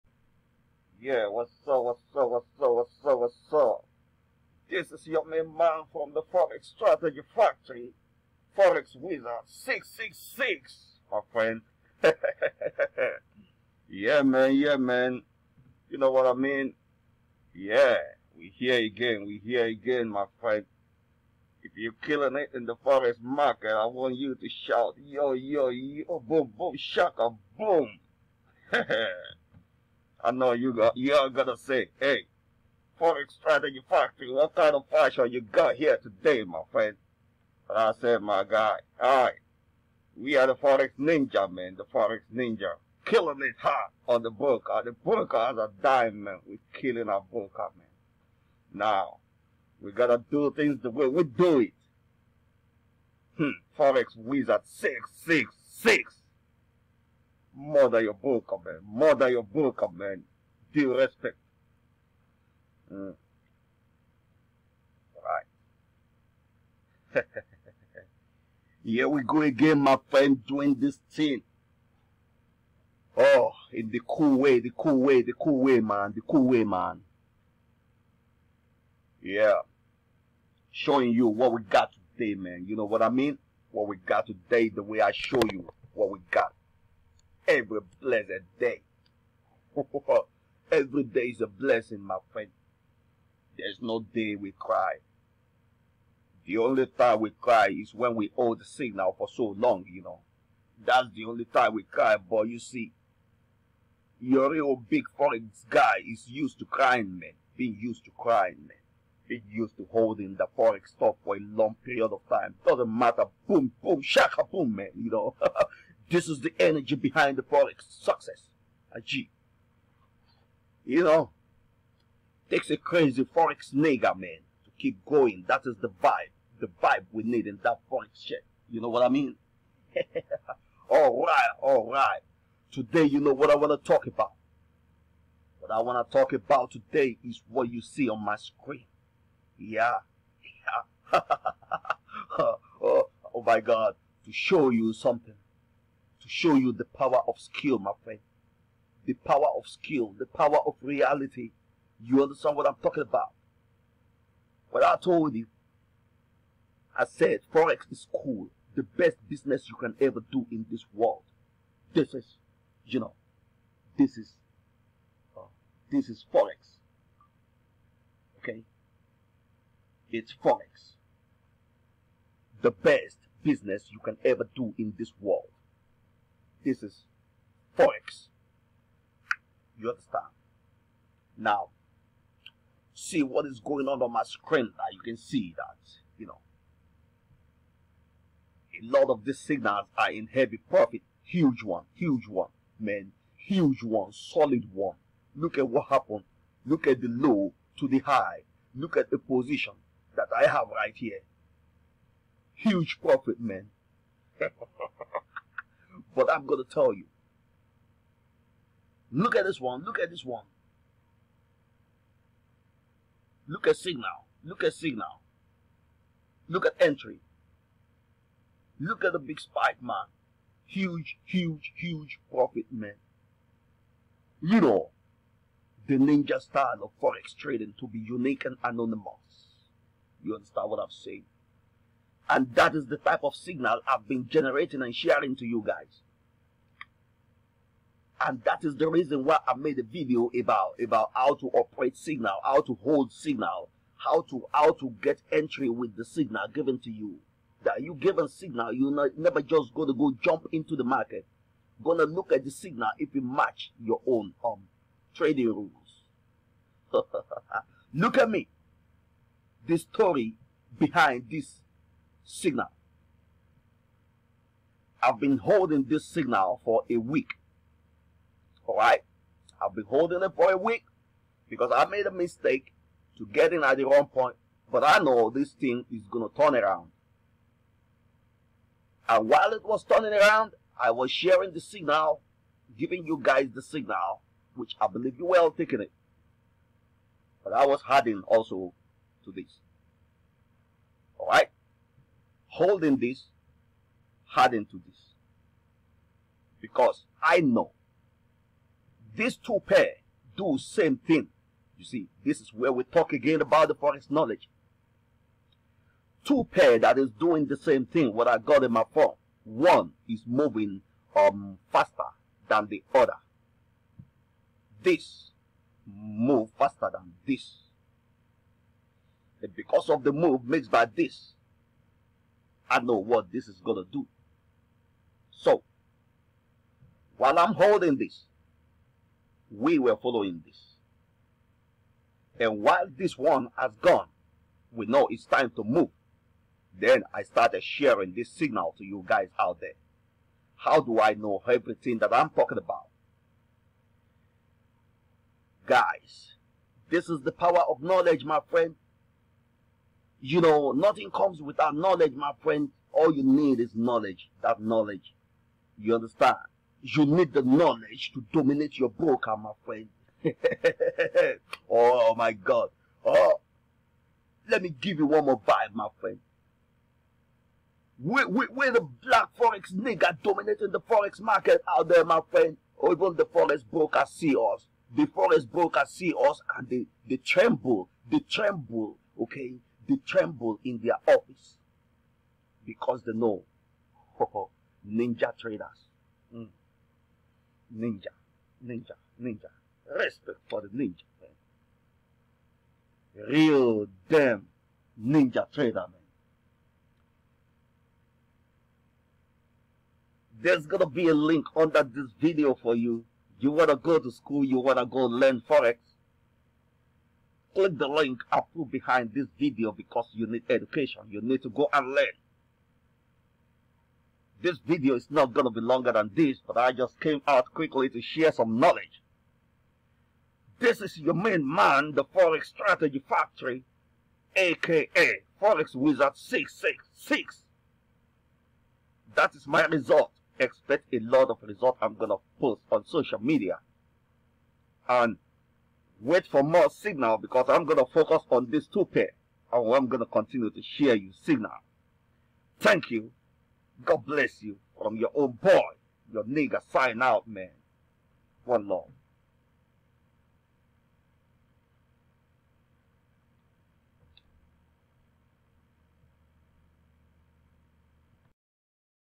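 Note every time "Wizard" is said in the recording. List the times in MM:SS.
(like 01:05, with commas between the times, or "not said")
00:08, 00:54, 07:05.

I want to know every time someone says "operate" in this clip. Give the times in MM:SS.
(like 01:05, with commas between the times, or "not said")
04:01.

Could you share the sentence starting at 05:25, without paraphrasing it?
So, while I'm holding this, we were following this.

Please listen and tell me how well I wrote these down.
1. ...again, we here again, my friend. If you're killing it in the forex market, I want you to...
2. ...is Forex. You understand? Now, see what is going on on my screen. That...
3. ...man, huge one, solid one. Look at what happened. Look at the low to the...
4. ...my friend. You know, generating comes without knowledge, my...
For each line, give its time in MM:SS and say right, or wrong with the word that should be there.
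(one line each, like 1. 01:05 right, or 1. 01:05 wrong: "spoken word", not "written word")
1. 00:18 right
2. 02:56 right
3. 03:12 right
4. 05:48 wrong: "nothing", not "generating".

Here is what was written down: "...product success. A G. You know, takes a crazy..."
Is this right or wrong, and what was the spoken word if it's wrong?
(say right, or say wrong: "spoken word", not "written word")
right.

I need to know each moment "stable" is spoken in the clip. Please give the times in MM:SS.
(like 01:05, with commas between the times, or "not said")
not said.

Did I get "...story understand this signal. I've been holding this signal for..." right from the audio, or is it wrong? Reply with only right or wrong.
wrong.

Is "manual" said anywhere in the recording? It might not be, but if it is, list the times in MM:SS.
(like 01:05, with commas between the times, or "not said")
not said.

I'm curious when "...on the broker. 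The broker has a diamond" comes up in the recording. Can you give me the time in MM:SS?
00:44.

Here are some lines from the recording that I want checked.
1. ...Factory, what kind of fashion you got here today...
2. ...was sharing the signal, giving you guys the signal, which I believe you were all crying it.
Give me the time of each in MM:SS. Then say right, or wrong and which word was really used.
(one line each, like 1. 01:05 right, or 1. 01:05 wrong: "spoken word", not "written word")
1. 00:33 right
2. 04:40 wrong: "taking", not "crying".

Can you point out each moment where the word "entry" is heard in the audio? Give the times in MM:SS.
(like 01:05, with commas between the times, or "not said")
03:36, 04:05.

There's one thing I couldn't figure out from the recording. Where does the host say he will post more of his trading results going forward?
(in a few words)
Social media.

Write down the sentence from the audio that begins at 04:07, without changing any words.
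That you given signal, you not, never just gonna go jump into the market.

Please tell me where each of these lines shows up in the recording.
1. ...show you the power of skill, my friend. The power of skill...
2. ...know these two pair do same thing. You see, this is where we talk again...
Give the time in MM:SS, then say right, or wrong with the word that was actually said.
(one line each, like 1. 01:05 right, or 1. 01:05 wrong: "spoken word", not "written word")
1. 02:26 right
2. 04:57 right.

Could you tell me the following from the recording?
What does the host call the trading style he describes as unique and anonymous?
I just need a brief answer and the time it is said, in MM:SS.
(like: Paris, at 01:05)
Ninja style, at 03:45.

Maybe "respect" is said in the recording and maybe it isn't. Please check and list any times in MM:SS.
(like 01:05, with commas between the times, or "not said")
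01:00, 06:29.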